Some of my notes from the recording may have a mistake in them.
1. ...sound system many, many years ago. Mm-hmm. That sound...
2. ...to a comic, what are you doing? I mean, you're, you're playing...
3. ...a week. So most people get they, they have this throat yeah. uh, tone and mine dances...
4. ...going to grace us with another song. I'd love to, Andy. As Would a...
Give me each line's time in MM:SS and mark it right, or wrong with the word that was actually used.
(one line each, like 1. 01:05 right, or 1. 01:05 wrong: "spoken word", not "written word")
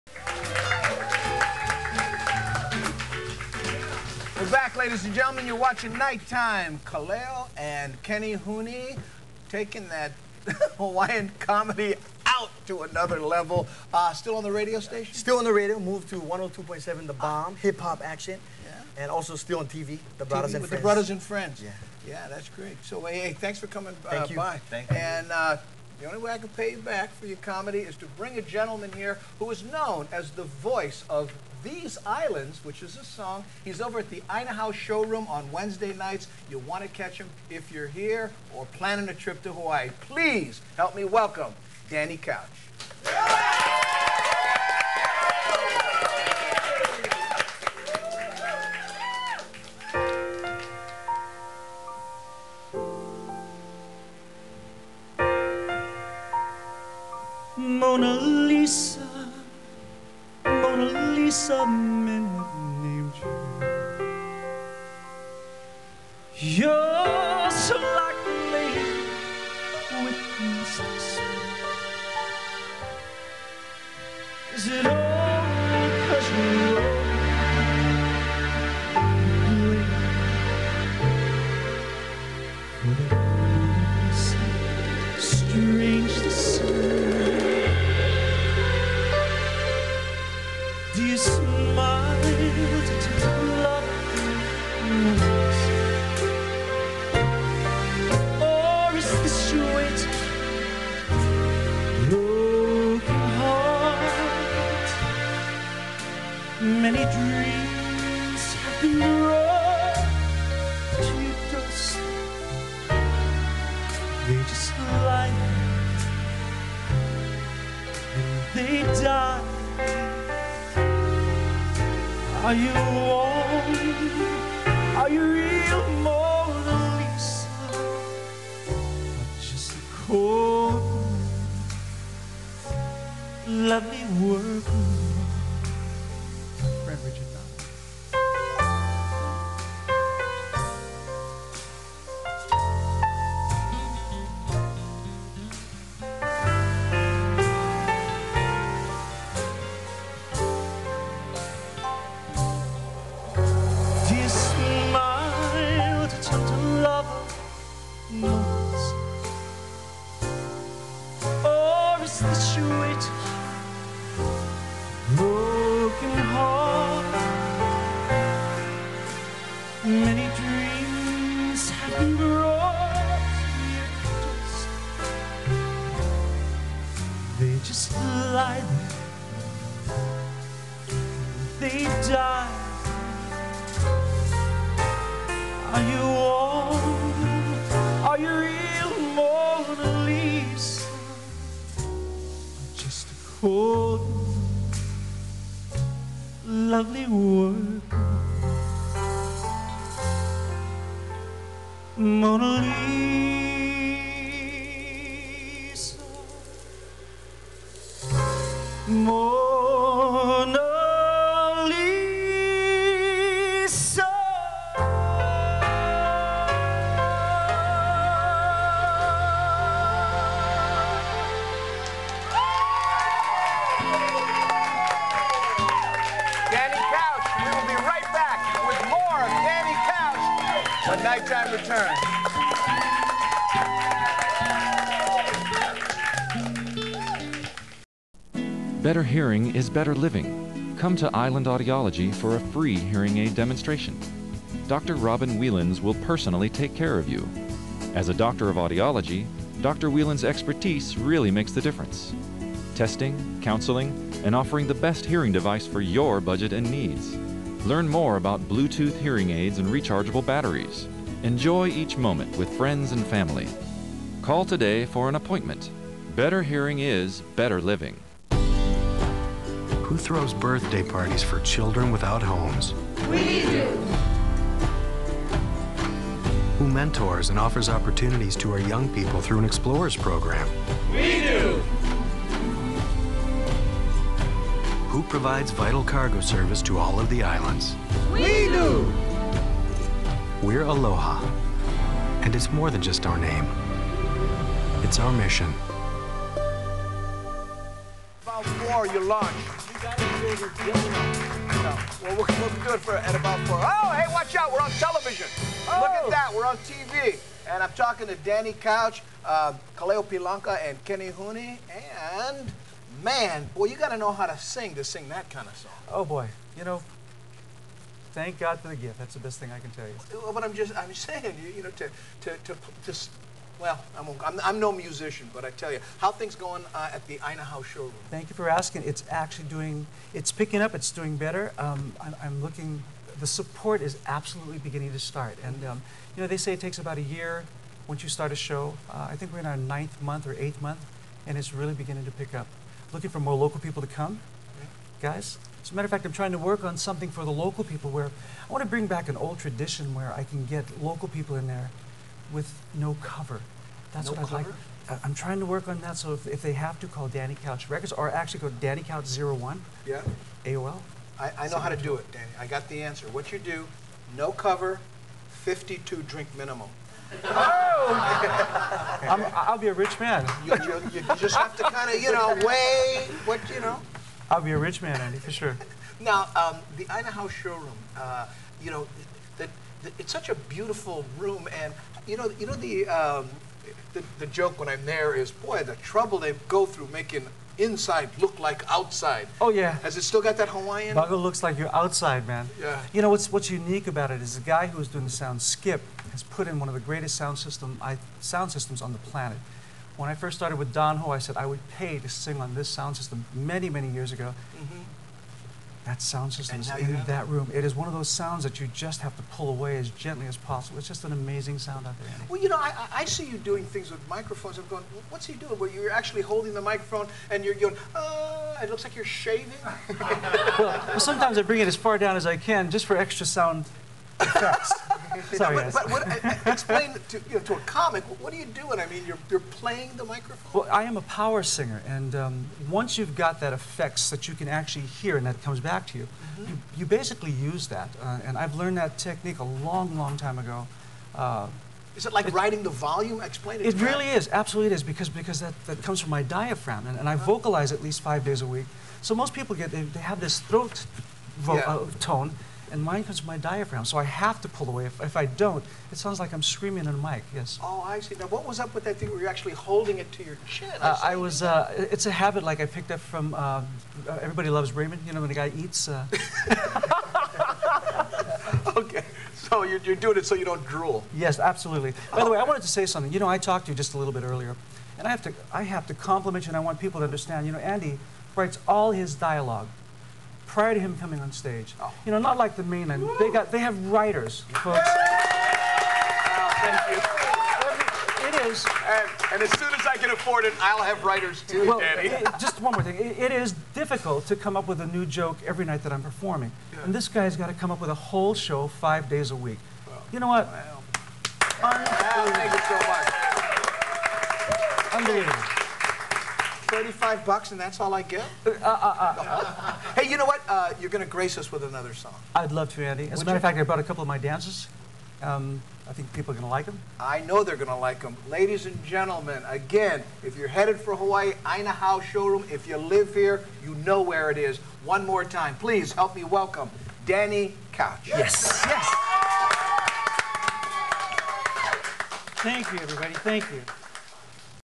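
1. 06:42 right
2. 07:07 right
3. 07:28 wrong: "comes", not "dances"
4. 08:30 right.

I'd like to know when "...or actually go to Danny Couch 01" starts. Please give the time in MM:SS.
05:57.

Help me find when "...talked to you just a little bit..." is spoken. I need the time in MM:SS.
07:53.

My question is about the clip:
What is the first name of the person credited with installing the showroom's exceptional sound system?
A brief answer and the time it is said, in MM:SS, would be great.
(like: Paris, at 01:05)
Skip, at 06:35.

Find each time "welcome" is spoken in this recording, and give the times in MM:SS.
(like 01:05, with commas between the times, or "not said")
00:41, 08:46.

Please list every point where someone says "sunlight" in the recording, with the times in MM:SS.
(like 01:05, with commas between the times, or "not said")
not said.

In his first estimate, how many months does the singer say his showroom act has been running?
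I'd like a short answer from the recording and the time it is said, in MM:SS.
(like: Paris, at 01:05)
9, at 05:39.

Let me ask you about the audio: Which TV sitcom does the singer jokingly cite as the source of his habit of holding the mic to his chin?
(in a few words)
Everybody Loves Raymond.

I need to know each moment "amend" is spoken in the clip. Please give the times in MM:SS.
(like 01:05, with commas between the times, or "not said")
not said.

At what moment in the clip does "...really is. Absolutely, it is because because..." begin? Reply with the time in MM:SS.
07:23.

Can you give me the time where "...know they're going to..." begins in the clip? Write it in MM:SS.
08:37.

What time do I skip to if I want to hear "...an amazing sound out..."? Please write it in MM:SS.
06:51.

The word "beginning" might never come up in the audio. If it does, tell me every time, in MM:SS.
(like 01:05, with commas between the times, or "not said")
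05:34, 05:41.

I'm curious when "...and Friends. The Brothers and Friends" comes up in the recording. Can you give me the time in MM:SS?
00:20.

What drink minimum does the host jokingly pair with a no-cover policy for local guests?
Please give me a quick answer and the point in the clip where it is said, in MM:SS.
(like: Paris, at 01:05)
52, at 06:05.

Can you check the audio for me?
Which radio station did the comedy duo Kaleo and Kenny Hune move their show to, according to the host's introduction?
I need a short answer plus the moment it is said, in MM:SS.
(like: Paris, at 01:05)
102.7 The Bomb, at 00:16.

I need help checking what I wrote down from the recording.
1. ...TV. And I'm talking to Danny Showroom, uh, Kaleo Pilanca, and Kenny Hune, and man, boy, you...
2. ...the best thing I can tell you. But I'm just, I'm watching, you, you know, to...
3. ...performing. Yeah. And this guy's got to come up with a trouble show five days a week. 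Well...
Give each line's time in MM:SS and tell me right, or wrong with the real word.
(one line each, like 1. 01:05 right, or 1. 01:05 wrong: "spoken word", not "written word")
1. 05:06 wrong: "Couch", not "Showroom"
2. 05:19 wrong: "saying", not "watching"
3. 08:16 wrong: "whole", not "trouble".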